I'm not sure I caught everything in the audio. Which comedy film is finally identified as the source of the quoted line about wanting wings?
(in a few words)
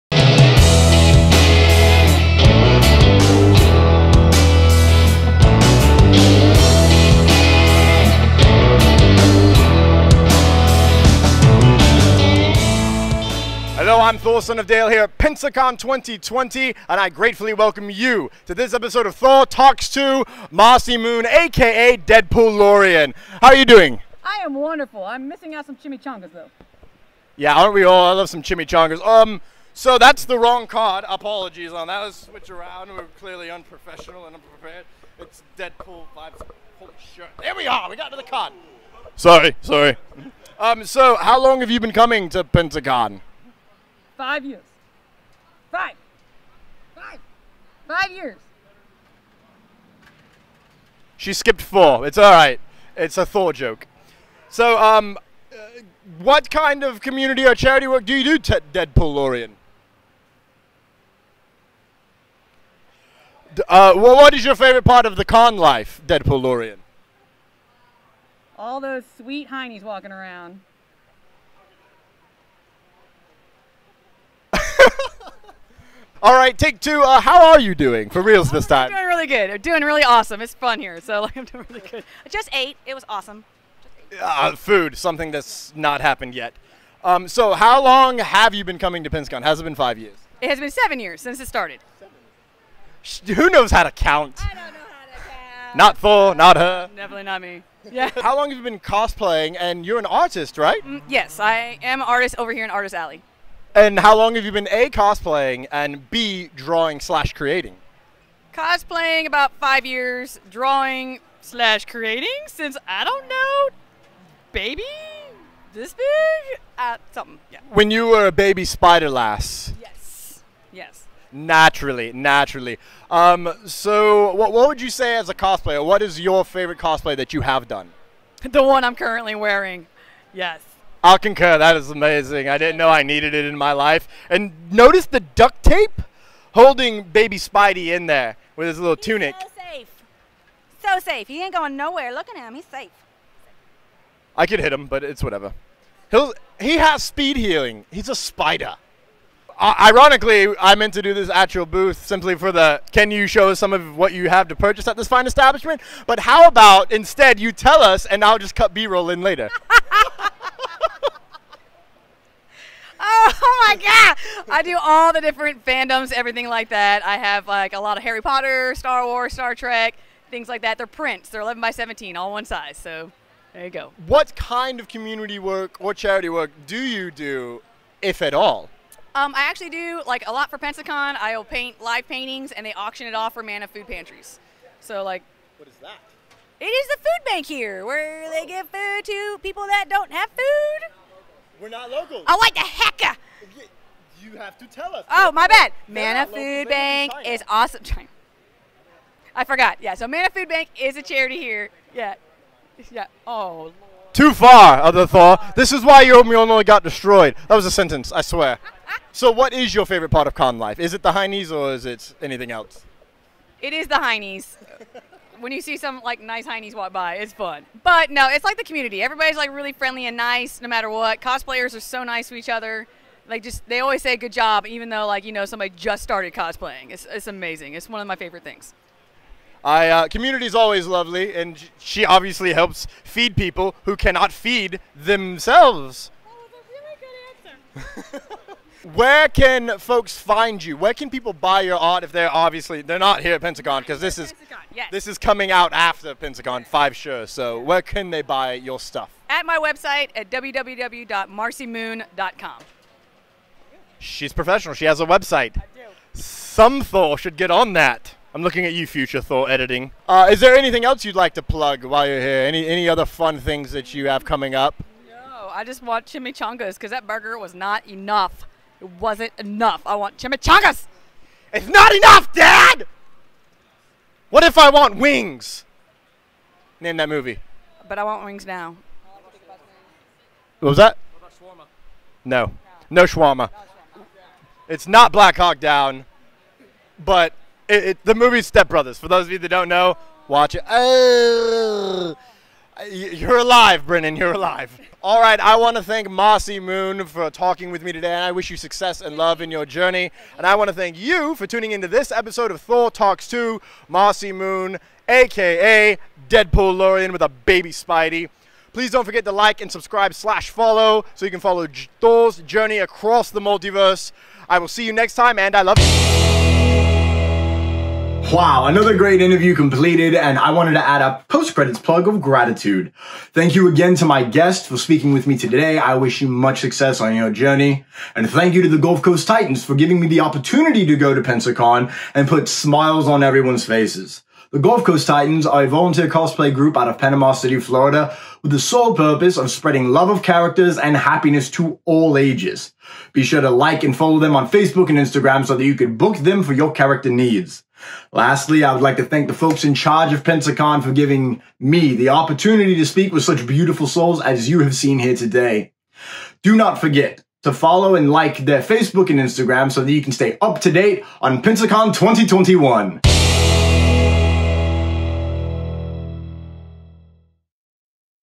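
Step Brothers.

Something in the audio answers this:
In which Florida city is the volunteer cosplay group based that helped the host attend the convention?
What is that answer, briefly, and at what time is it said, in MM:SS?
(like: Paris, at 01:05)
Panama City, at 05:36.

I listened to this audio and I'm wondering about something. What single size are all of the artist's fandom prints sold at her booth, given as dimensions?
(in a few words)
11 by 17.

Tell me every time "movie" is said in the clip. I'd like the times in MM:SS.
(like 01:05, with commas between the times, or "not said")
04:37, 04:48.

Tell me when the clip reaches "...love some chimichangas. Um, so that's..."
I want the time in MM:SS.
00:28.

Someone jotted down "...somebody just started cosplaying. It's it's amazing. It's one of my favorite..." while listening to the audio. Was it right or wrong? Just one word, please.
right.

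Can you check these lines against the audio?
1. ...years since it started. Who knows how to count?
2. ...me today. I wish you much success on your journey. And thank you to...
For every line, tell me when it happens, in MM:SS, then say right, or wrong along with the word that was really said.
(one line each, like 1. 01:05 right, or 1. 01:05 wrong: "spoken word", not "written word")
1. 01:30 right
2. 05:25 right.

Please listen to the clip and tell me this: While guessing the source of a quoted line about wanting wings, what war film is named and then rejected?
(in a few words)
Black Hawk Down.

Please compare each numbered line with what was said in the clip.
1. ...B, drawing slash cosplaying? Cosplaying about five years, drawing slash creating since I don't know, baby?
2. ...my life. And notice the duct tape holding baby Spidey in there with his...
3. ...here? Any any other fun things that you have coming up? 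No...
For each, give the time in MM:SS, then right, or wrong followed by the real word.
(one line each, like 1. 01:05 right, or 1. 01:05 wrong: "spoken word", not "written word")
1. 01:46 wrong: "creating", not "cosplaying"
2. 02:13 right
3. 04:22 right.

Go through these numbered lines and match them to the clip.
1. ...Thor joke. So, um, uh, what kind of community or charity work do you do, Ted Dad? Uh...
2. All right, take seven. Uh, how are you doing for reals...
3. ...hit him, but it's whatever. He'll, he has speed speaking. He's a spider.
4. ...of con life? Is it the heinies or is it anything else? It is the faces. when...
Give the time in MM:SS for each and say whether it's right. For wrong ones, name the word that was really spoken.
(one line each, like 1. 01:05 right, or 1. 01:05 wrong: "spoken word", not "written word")
1. 00:53 wrong: "Deadpoolorian", not "Dad"
2. 01:16 wrong: "two", not "seven"
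3. 02:24 wrong: "healing", not "speaking"
4. 03:30 wrong: "heinies", not "faces".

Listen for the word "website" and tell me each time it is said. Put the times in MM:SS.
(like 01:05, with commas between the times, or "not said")
04:09, 04:15.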